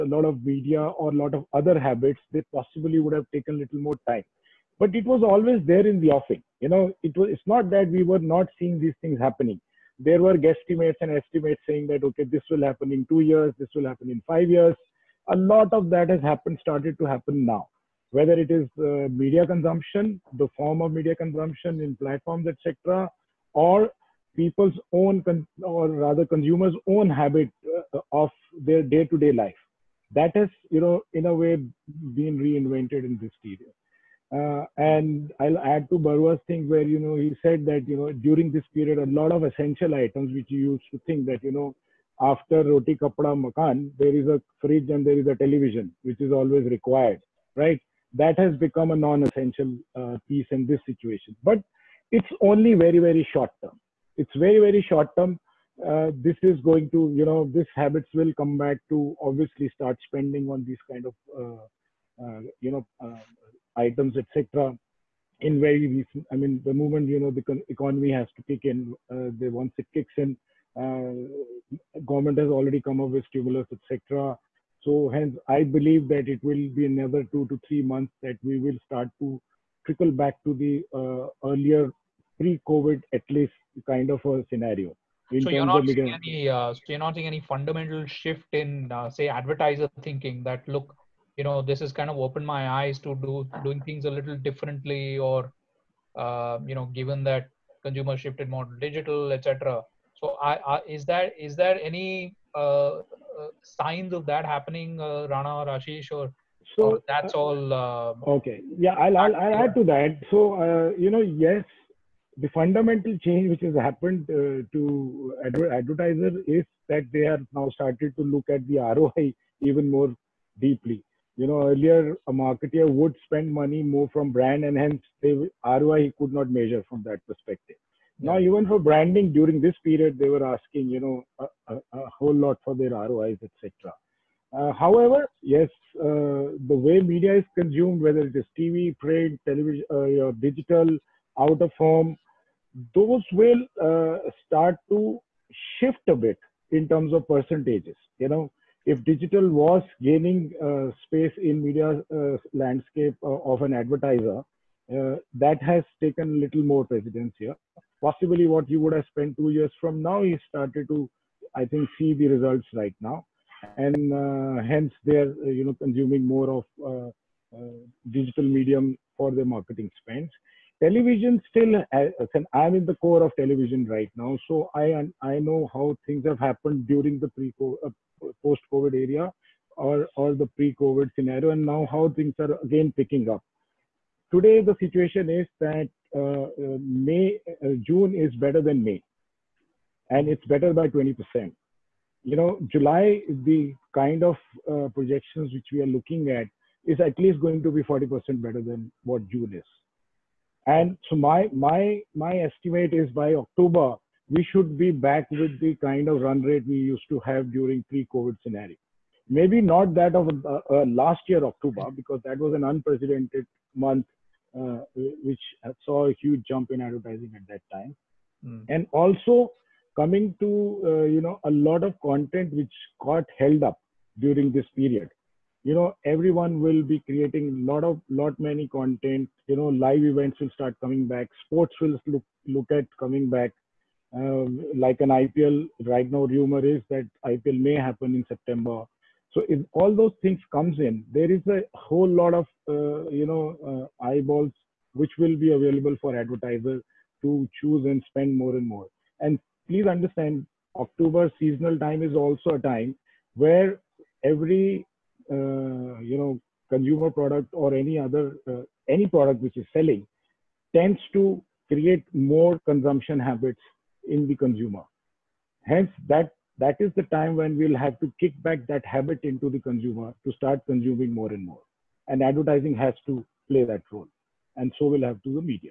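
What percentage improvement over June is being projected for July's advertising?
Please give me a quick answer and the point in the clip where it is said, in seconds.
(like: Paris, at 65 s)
40%, at 197 s.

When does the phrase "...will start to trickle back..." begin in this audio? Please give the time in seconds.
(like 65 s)
78 s.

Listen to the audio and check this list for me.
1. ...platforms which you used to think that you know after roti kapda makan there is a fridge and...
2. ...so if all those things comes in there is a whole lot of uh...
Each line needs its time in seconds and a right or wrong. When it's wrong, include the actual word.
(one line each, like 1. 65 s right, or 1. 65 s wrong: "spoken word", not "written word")
1. 39 s wrong: "items", not "platforms"
2. 239 s right.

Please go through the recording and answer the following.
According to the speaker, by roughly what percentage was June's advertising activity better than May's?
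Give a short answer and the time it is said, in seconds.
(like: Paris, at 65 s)
20%, at 190 s.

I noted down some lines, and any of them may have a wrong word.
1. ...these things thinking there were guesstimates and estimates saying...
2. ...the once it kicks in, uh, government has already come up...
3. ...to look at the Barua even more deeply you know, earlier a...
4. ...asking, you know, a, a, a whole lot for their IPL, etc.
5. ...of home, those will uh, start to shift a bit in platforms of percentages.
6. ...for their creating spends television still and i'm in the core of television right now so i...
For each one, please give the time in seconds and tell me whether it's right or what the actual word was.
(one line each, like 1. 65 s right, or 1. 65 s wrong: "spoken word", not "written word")
1. 8 s wrong: "happening", not "thinking"
2. 69 s right
3. 118 s wrong: "ROI", not "Barua"
4. 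130 s wrong: "ROIs", not "IPL"
5. 141 s wrong: "terms", not "platforms"
6. 169 s wrong: "marketing", not "creating".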